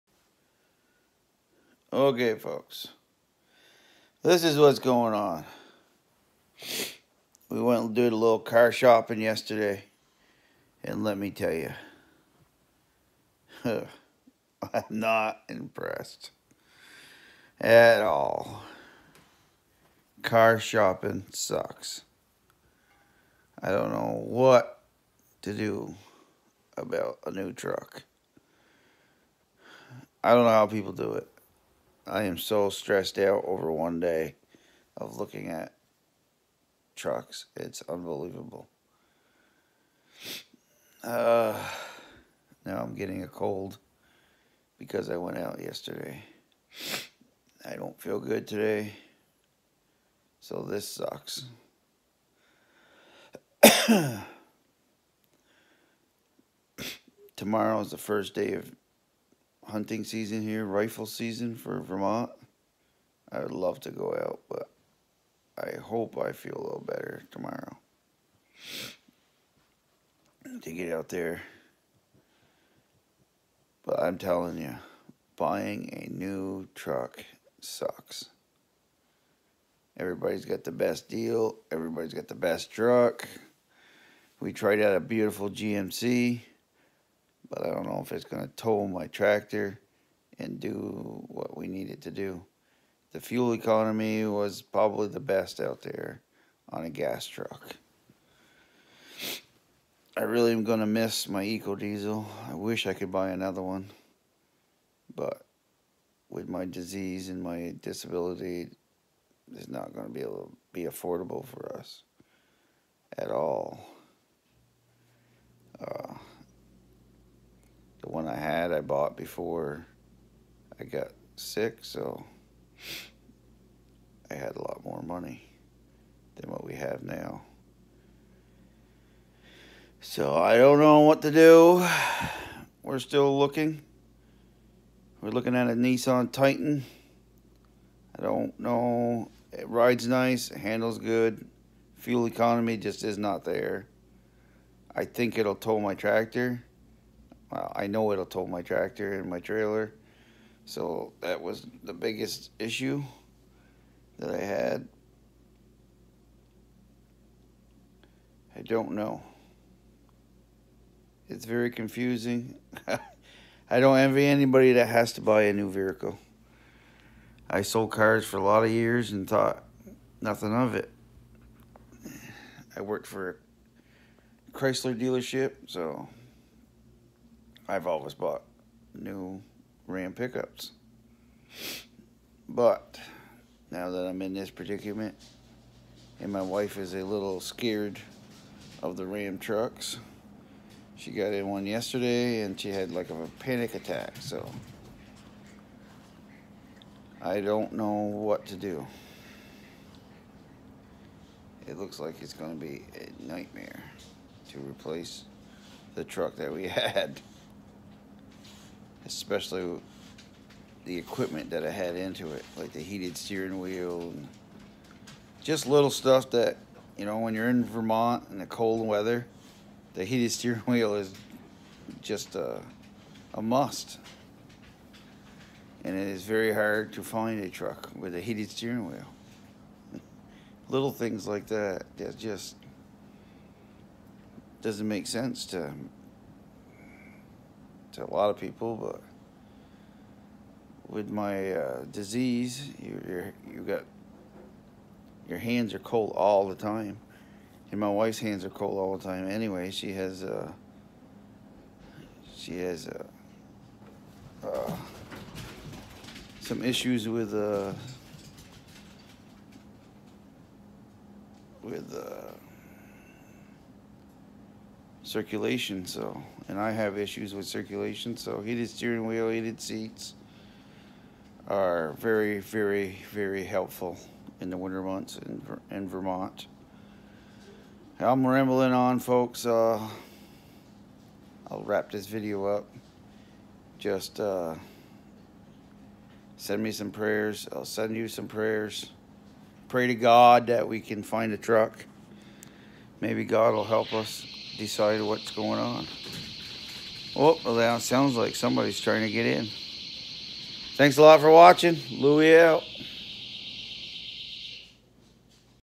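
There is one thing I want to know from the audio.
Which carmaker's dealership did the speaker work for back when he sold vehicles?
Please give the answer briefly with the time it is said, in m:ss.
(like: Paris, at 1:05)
Chrysler, at 2:54.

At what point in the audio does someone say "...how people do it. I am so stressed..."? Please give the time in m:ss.
0:30.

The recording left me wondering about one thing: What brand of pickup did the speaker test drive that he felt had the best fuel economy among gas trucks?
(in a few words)
GMC.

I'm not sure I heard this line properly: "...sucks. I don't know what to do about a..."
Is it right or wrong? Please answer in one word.
right.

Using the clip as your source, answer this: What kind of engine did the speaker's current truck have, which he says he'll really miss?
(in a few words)
Eco Diesel.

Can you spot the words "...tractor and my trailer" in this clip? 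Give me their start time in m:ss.
2:28.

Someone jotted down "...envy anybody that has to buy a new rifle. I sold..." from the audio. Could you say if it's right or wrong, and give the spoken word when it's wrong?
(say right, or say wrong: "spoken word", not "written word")
wrong: "vehicle", not "rifle".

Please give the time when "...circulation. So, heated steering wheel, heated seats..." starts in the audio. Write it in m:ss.
4:27.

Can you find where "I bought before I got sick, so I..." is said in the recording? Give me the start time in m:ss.
1:58.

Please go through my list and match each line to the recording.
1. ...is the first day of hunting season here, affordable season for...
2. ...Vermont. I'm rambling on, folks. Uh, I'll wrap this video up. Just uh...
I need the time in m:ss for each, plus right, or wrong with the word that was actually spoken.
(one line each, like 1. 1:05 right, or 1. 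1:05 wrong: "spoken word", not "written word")
1. 0:57 wrong: "rifle", not "affordable"
2. 4:35 right.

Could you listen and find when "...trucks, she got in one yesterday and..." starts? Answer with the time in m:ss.
3:09.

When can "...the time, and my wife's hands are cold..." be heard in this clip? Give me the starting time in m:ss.
4:06.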